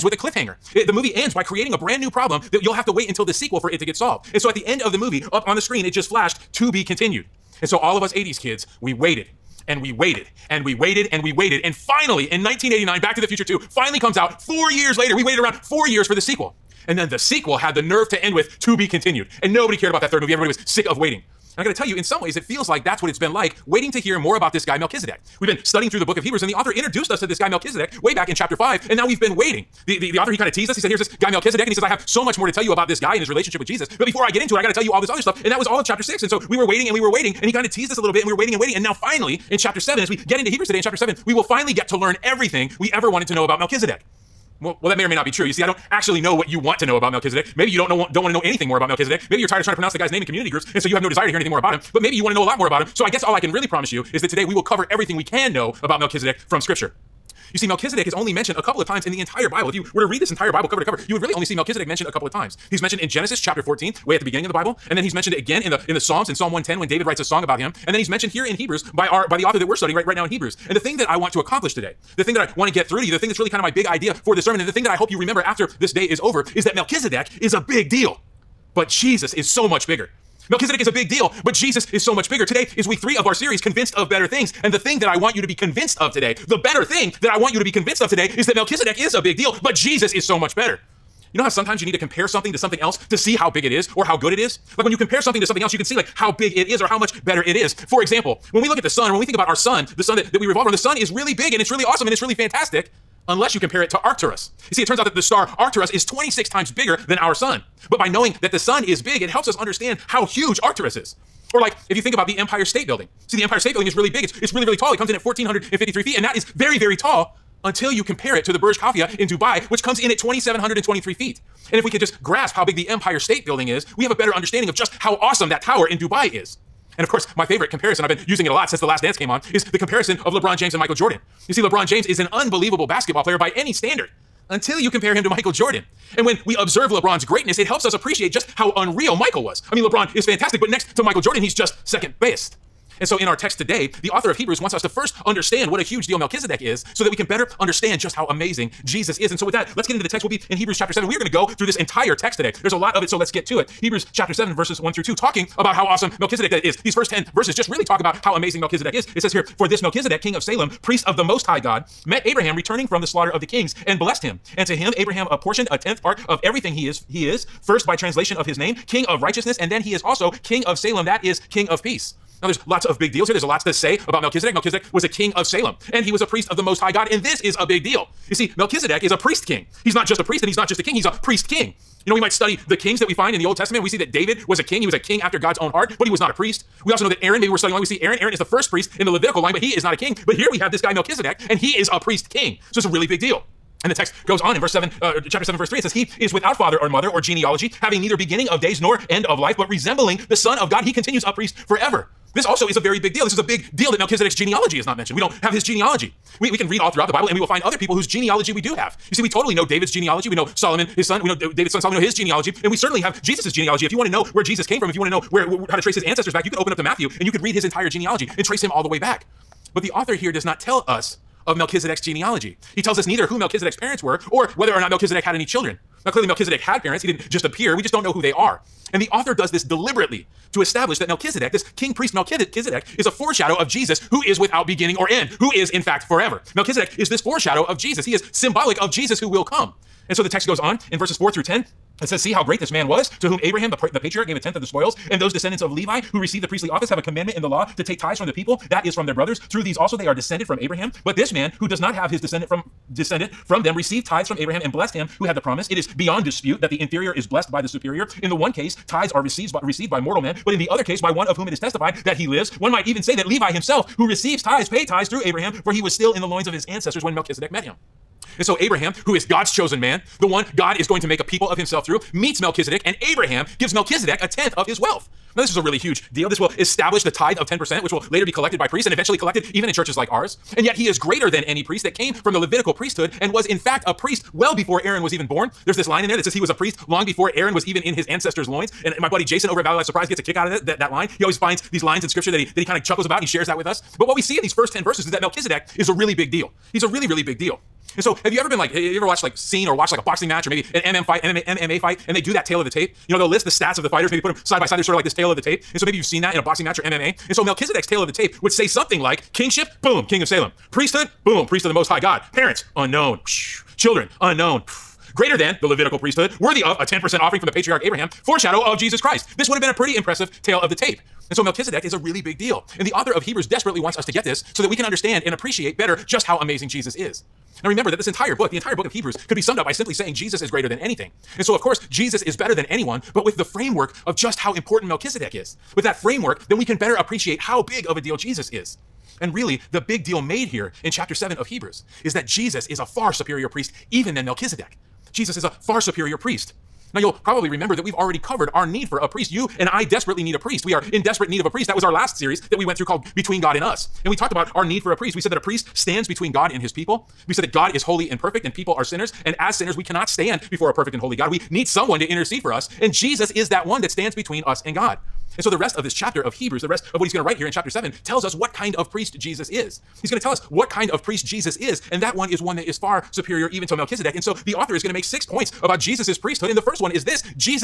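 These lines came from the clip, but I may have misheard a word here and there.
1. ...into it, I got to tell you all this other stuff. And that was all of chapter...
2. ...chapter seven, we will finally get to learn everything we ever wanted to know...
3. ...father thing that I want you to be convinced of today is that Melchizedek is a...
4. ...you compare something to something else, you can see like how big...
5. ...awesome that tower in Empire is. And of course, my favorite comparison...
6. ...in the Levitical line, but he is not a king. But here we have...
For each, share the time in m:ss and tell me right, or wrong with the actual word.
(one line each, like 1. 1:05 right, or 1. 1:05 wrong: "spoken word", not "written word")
1. 0:34 right
2. 0:40 right
3. 1:26 wrong: "better", not "father"
4. 1:34 right
5. 2:05 wrong: "Dubai", not "Empire"
6. 3:08 right.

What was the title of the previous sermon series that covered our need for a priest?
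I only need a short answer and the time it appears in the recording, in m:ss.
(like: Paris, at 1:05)
Between God and Us, at 5:53.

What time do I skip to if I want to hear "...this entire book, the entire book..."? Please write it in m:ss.
5:27.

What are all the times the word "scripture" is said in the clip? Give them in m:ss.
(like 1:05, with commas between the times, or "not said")
0:56, 4:52.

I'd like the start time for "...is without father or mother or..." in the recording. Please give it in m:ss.
3:16.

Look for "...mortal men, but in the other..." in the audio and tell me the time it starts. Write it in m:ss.
4:19.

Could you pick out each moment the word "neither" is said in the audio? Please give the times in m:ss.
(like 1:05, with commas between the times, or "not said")
3:18, 3:43.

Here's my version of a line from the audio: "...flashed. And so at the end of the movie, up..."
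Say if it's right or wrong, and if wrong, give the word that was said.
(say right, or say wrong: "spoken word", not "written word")
wrong: "solved", not "flashed".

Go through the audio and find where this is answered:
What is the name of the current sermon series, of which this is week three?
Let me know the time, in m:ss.
1:23.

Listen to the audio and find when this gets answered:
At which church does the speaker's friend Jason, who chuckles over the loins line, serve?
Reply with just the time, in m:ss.
4:49.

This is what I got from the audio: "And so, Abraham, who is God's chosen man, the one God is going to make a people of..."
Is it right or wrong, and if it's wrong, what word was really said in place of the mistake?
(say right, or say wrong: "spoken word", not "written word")
right.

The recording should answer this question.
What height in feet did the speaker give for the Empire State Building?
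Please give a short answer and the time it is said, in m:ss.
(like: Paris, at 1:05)
1,453, at 1:55.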